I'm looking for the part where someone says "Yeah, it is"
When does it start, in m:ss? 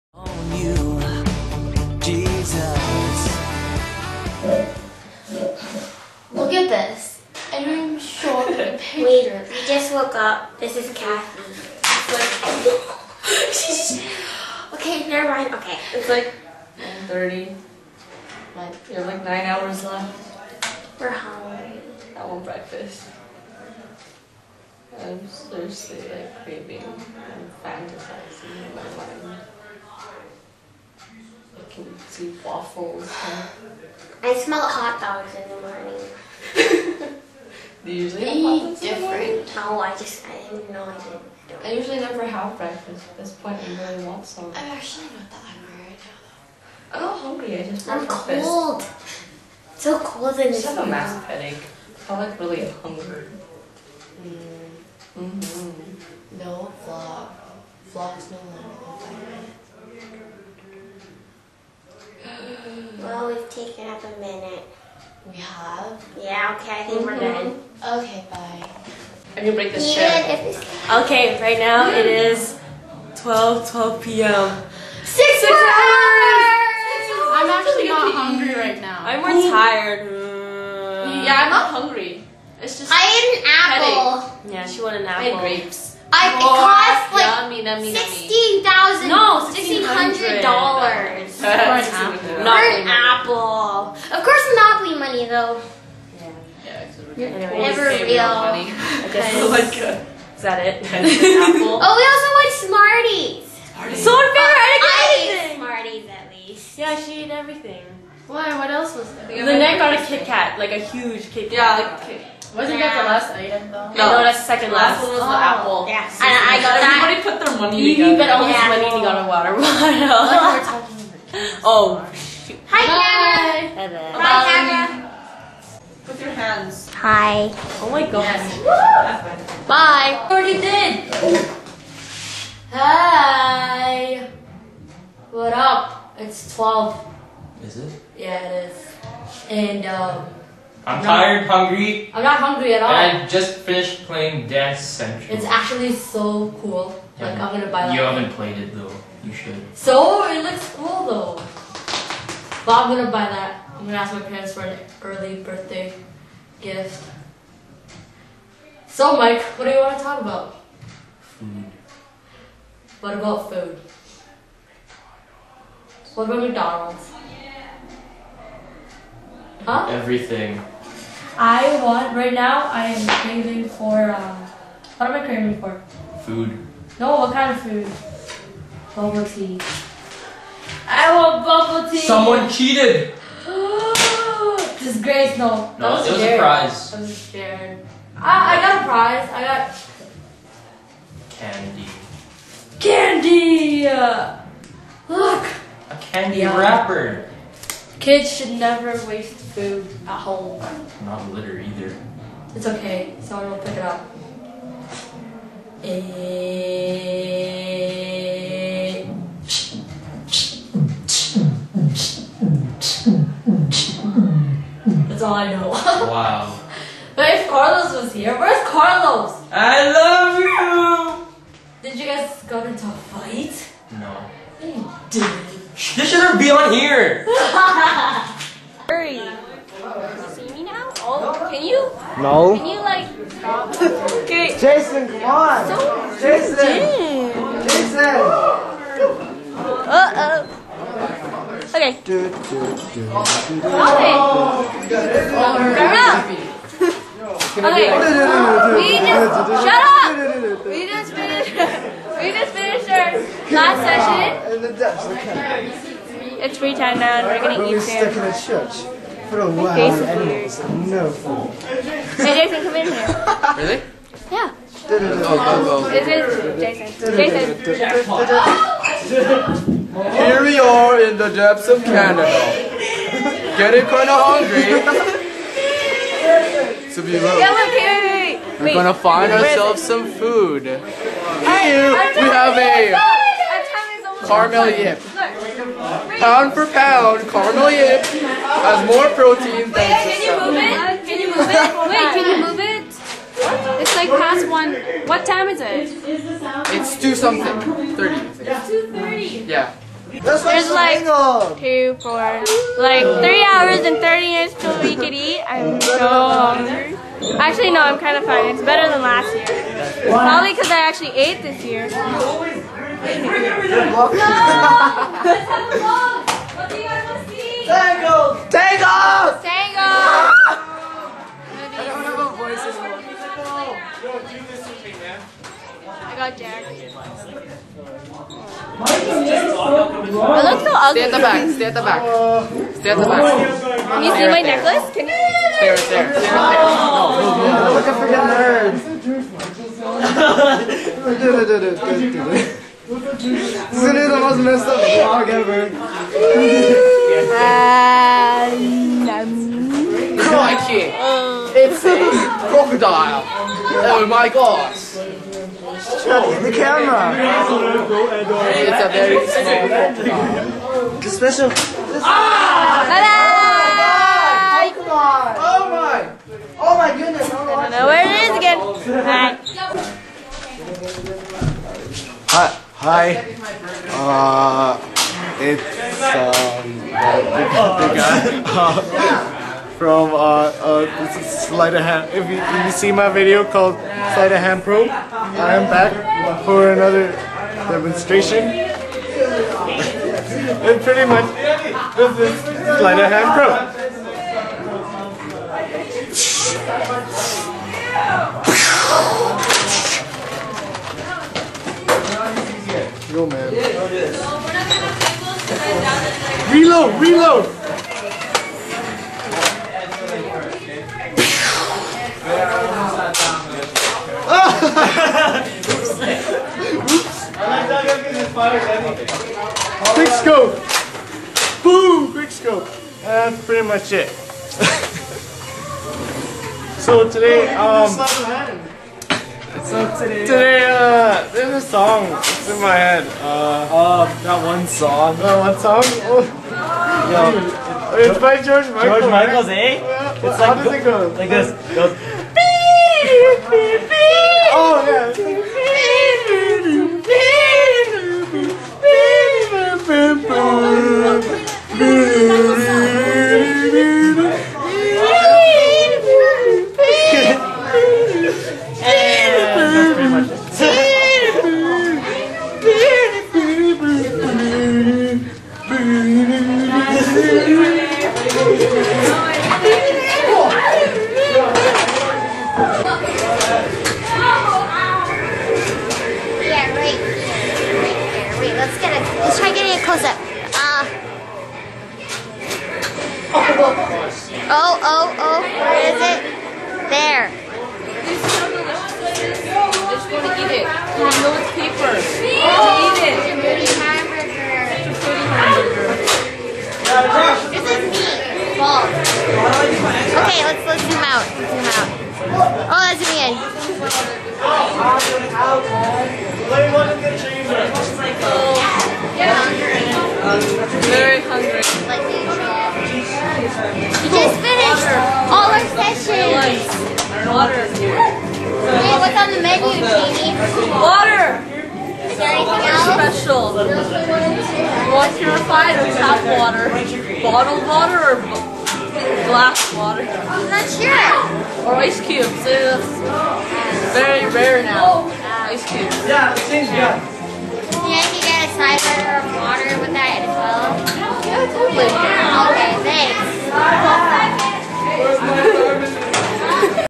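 2:18.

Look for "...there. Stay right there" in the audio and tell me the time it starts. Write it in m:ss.
5:35.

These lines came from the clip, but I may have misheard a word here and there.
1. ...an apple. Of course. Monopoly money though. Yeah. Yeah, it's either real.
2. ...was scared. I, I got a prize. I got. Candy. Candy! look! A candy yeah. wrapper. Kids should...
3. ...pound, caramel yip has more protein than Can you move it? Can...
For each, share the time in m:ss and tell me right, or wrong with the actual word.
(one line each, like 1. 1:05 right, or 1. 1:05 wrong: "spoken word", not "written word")
1. 1:32 wrong: "never", not "either"
2. 3:07 right
3. 4:46 right.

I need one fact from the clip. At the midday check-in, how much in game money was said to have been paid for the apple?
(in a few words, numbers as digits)
$1,600.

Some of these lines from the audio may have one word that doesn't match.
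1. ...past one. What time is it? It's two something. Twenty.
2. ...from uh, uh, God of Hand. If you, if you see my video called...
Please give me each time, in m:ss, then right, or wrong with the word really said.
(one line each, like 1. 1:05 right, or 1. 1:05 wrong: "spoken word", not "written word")
1. 4:54 wrong: "Thirty", not "Twenty"
2. 6:19 wrong: "Sleight", not "God".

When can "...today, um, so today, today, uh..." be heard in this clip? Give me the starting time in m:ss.
7:07.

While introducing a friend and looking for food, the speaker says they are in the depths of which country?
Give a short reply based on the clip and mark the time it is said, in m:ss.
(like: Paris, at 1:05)
Canada, at 4:31.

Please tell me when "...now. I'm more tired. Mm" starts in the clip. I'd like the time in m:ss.
1:18.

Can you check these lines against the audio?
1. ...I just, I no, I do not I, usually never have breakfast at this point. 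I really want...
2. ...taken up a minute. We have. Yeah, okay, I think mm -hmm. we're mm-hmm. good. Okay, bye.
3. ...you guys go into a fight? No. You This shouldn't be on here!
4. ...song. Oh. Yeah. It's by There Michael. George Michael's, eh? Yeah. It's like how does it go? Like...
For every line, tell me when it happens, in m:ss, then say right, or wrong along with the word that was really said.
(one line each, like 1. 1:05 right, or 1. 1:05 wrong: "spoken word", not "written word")
1. 0:39 right
2. 1:03 right
3. 3:41 right
4. 7:15 wrong: "George", not "There".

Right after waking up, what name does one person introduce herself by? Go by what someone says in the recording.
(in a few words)
Kathy.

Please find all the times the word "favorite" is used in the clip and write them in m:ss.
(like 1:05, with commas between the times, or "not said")
1:44.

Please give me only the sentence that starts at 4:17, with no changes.
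We're stuck in a church for a while.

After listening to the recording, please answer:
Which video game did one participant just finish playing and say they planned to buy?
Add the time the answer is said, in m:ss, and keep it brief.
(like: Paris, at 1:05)
Dance Central, at 2:24.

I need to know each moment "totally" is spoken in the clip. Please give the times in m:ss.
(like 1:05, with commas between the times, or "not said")
9:01.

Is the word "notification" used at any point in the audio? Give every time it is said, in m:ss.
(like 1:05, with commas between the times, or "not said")
not said.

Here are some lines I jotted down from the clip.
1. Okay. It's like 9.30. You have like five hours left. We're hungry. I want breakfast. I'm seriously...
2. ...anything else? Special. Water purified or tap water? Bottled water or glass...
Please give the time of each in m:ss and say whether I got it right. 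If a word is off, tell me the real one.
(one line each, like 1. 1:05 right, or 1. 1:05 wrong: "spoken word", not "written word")
1. 0:15 wrong: "nine", not "five"
2. 8:42 right.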